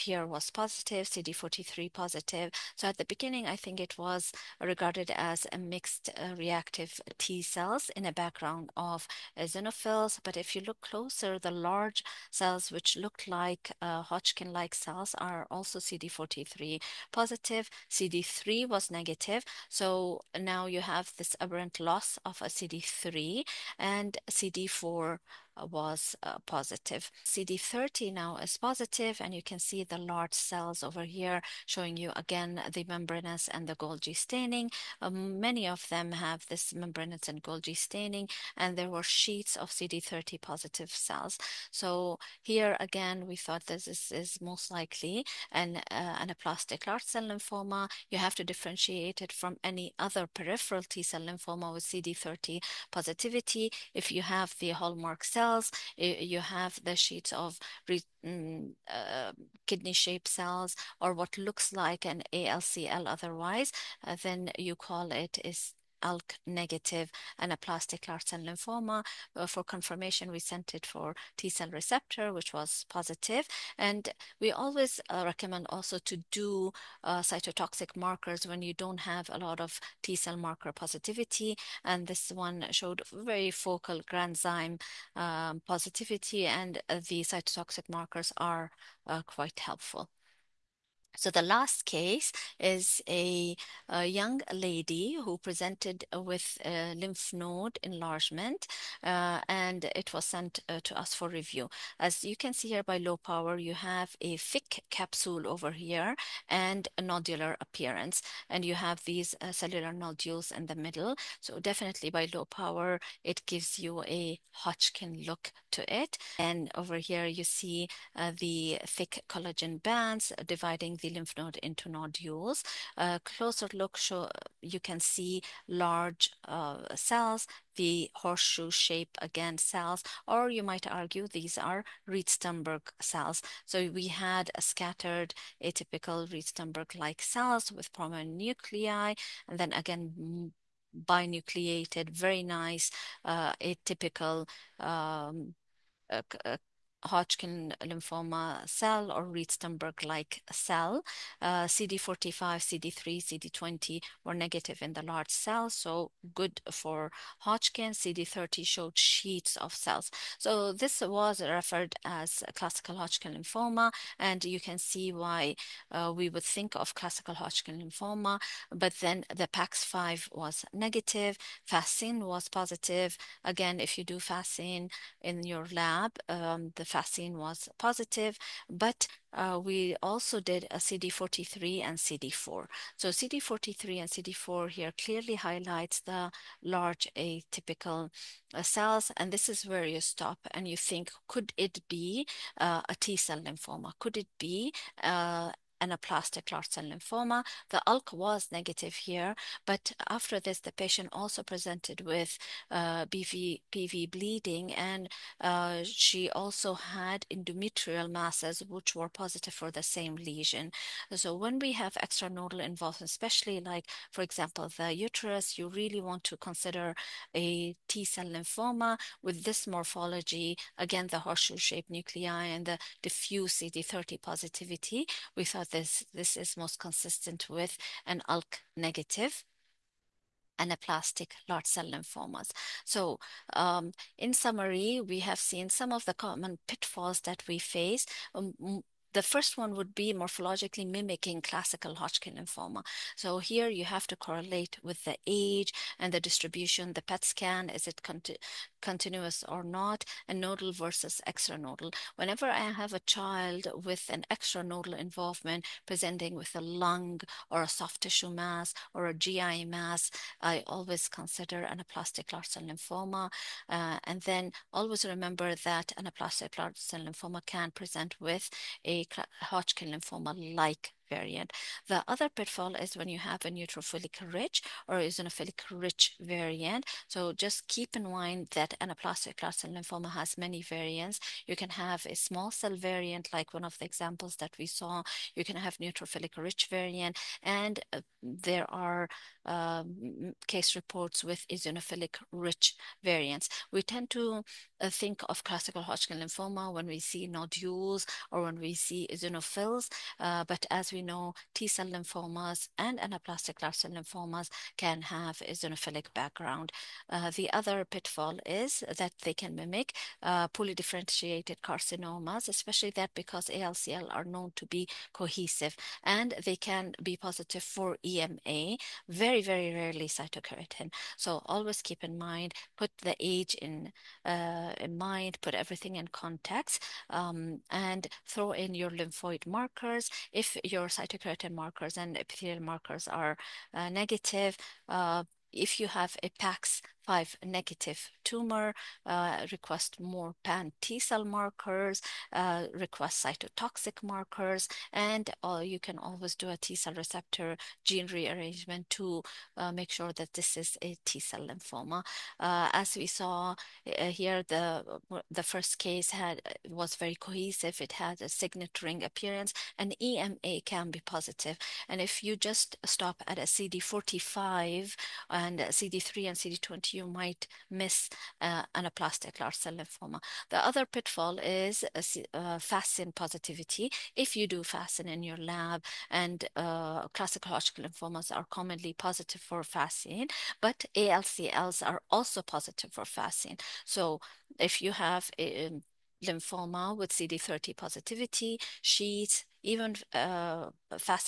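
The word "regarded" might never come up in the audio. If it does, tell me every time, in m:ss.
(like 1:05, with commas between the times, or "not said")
0:04.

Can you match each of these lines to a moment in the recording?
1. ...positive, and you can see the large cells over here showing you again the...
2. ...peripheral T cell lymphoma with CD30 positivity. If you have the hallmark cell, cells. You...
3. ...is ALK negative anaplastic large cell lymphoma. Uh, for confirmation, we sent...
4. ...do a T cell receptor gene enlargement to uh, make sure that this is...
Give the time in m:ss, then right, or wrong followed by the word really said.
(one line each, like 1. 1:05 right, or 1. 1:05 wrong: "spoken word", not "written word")
1. 0:28 right
2. 0:50 right
3. 1:05 right
4. 5:46 wrong: "rearrangement", not "enlargement".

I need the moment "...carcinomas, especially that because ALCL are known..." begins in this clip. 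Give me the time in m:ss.
5:11.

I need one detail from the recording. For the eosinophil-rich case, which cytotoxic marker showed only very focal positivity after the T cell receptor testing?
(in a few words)
granzyme.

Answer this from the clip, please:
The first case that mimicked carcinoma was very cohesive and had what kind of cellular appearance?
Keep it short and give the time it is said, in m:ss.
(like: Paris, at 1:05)
signet ring, at 5:58.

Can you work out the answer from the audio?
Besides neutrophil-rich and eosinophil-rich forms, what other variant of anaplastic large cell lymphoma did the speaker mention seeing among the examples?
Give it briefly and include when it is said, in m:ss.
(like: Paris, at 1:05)
small cell variant, at 4:42.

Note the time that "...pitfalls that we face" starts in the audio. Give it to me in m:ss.
3:56.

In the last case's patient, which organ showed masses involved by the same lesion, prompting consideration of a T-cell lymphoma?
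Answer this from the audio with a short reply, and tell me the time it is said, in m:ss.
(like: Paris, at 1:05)
uterus, at 3:34.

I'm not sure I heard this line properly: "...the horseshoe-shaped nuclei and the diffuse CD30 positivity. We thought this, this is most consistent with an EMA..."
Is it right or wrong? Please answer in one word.
wrong.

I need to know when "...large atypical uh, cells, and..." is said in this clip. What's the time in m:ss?
3:06.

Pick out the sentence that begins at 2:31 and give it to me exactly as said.
Uh, CD45, CD3, CD20 were negative in the large cell, so good for Hodgkin.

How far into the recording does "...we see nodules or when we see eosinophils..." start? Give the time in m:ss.
4:56.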